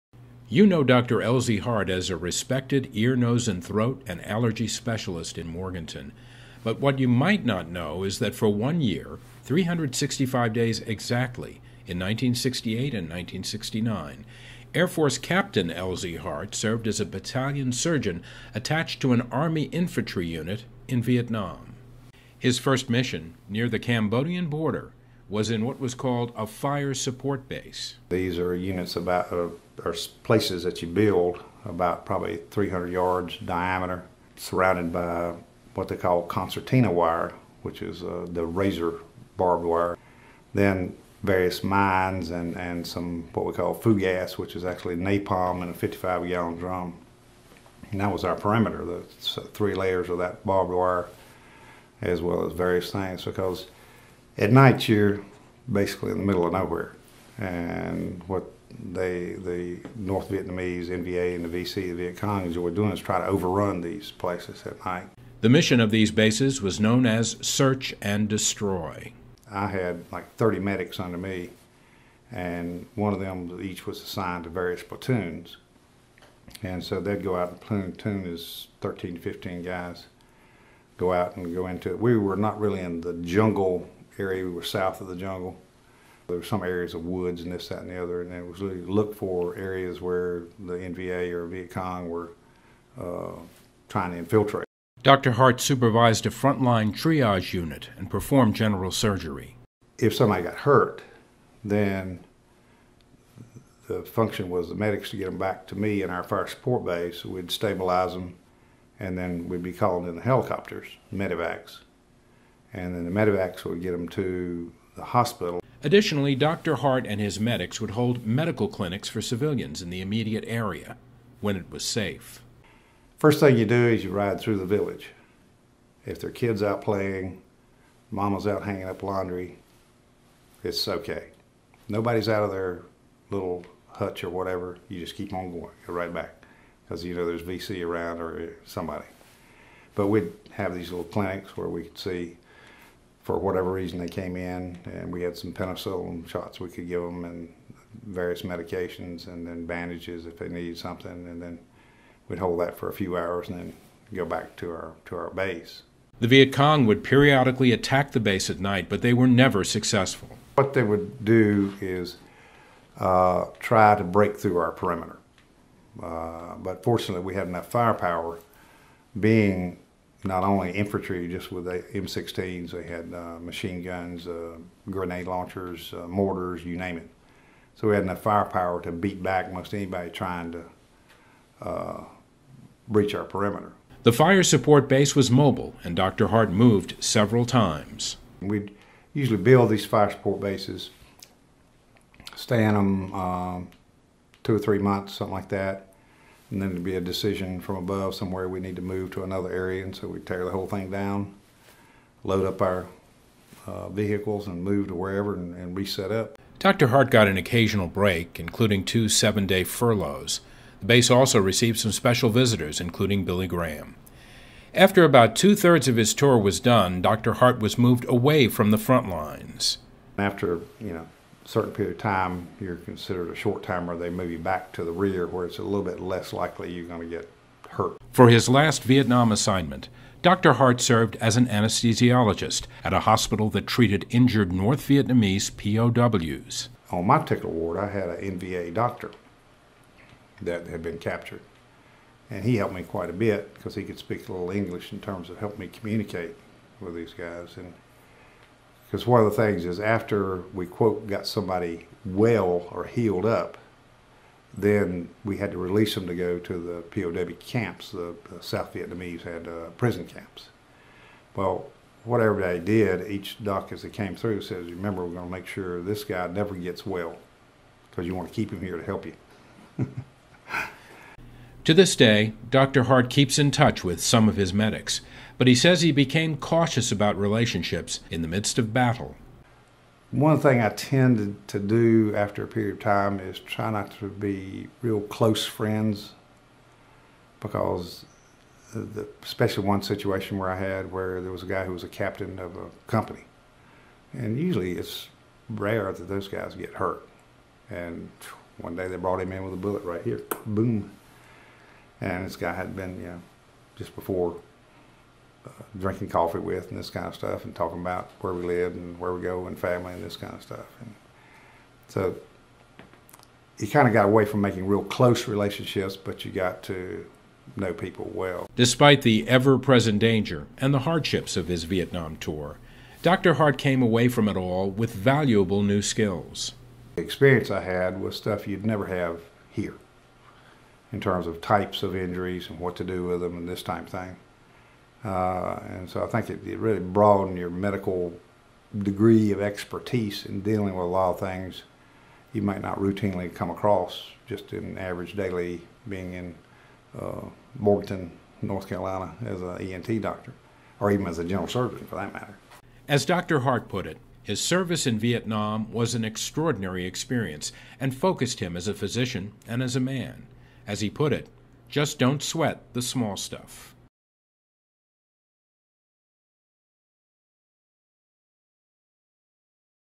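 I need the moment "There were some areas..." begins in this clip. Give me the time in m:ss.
1:26.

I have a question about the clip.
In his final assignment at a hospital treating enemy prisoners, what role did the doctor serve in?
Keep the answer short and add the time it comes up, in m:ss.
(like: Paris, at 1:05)
anesthesiologist, at 3:51.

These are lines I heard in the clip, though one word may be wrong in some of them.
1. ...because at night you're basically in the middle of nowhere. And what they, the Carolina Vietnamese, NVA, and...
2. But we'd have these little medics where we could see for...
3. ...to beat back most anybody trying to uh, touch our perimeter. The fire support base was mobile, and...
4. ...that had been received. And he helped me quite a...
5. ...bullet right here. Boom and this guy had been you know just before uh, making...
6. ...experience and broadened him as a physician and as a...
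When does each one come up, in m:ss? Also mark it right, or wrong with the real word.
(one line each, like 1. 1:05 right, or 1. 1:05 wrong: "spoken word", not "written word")
1. 0:53 wrong: "North", not "Carolina"
2. 2:19 wrong: "clinics", not "medics"
3. 2:58 wrong: "breach", not "touch"
4. 4:00 wrong: "captured", not "received"
5. 4:59 wrong: "drinking", not "making"
6. 5:56 wrong: "focused", not "broadened".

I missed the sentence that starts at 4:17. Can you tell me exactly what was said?
The, the South Vietnamese had uh, prison camps.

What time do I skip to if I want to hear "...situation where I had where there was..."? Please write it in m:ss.
4:49.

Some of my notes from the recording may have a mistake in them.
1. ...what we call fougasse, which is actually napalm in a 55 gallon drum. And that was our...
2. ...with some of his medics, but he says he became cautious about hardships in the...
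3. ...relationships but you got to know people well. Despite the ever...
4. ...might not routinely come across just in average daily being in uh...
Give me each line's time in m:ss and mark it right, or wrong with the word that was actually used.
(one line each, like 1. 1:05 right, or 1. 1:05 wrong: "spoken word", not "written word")
1. 0:43 right
2. 4:33 wrong: "relationships", not "hardships"
3. 5:15 right
4. 5:42 right.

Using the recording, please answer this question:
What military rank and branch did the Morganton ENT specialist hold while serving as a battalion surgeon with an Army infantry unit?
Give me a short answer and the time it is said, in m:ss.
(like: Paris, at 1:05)
Air Force Captain, at 0:14.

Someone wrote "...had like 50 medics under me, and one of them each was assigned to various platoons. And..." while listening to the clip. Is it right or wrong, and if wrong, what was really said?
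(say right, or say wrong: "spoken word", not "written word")
wrong: "30", not "50".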